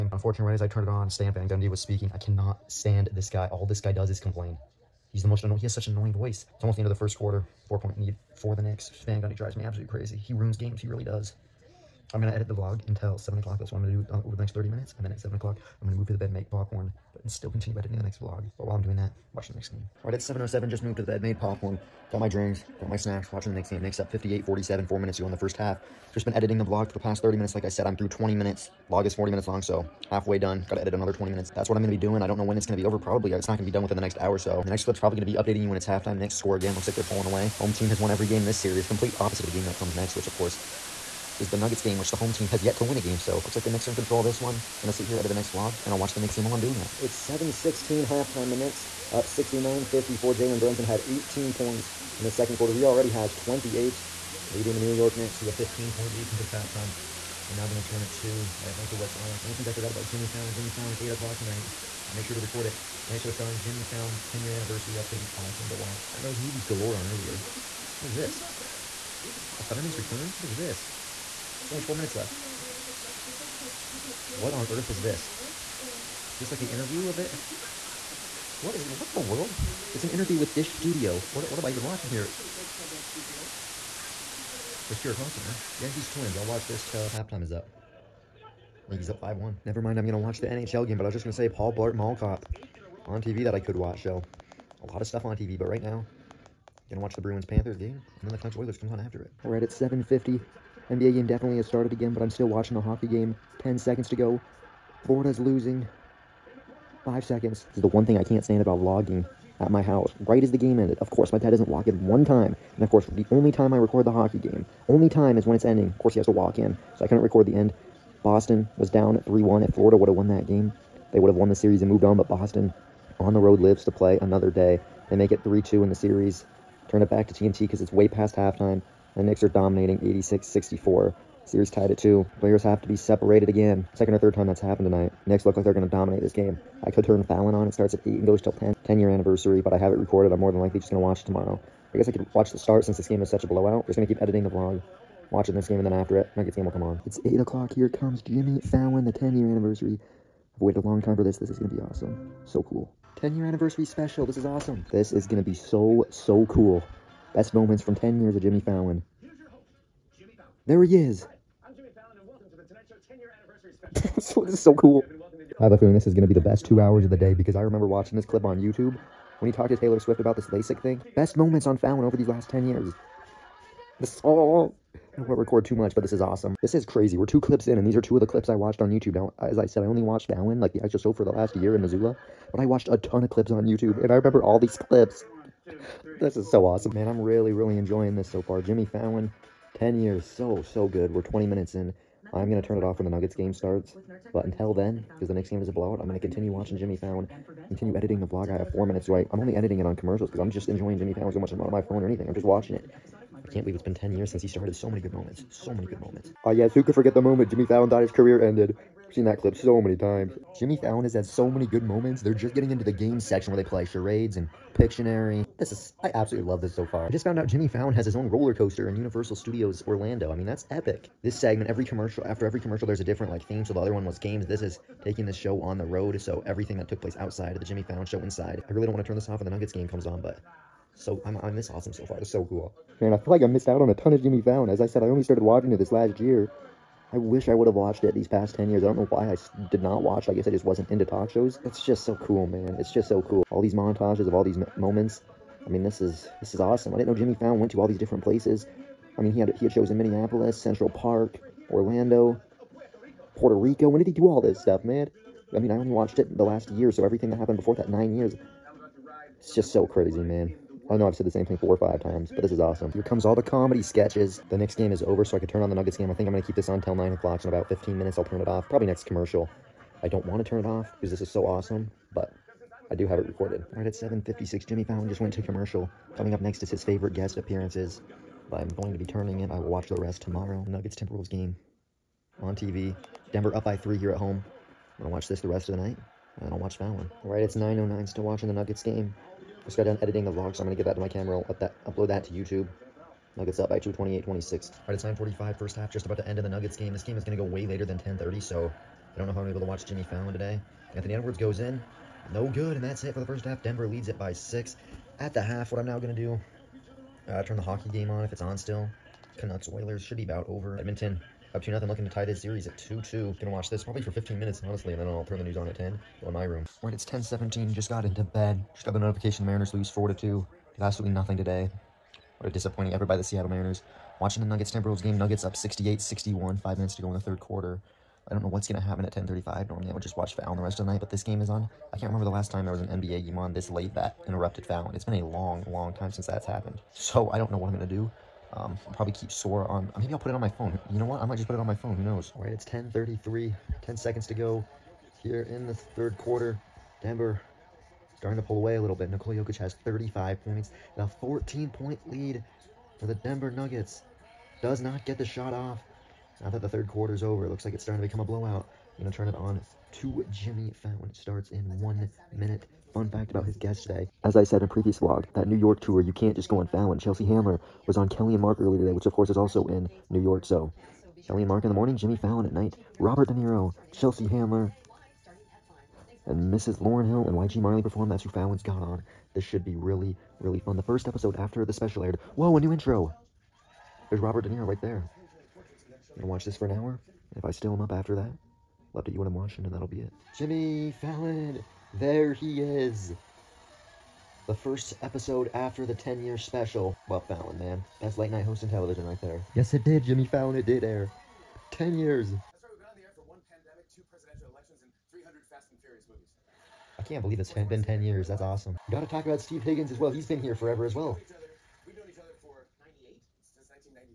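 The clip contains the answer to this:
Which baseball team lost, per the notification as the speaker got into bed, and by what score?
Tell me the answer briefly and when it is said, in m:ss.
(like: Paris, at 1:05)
Mariners, 4-2, at 5:19.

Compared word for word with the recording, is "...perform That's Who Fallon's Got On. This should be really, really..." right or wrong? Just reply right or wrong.
right.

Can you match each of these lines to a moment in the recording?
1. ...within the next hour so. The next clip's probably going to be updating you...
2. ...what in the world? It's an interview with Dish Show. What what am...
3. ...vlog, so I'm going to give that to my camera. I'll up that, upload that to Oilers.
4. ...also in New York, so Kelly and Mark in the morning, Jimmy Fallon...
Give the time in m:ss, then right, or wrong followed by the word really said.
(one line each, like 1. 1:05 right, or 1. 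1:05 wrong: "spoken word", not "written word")
1. 0:33 right
2. 1:18 wrong: "Studio", not "Show"
3. 4:50 wrong: "YouTube", not "Oilers"
4. 6:09 right.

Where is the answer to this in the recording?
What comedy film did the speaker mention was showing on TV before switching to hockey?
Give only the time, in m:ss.
1:31.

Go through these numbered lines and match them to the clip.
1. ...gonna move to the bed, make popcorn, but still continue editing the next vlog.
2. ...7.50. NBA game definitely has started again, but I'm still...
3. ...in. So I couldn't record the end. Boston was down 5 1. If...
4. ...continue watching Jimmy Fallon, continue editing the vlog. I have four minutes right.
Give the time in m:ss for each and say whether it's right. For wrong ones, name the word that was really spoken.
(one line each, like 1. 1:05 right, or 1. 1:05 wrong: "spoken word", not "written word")
1. 0:15 right
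2. 1:39 right
3. 1:56 wrong: "3", not "5"
4. 3:16 right.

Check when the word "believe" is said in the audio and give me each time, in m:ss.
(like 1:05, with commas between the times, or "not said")
3:23, 6:47.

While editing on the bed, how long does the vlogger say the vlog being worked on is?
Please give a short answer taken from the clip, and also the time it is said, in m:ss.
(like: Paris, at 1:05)
40 minutes, at 0:28.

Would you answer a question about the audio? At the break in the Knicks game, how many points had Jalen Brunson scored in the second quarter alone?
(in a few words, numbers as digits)
18.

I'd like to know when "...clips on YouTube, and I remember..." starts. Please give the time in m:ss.
3:03.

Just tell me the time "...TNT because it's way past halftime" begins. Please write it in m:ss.
2:07.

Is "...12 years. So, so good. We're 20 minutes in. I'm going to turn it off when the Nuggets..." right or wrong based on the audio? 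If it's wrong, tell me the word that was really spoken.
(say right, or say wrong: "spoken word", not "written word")
wrong: "10", not "12".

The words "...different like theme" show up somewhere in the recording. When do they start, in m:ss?
3:43.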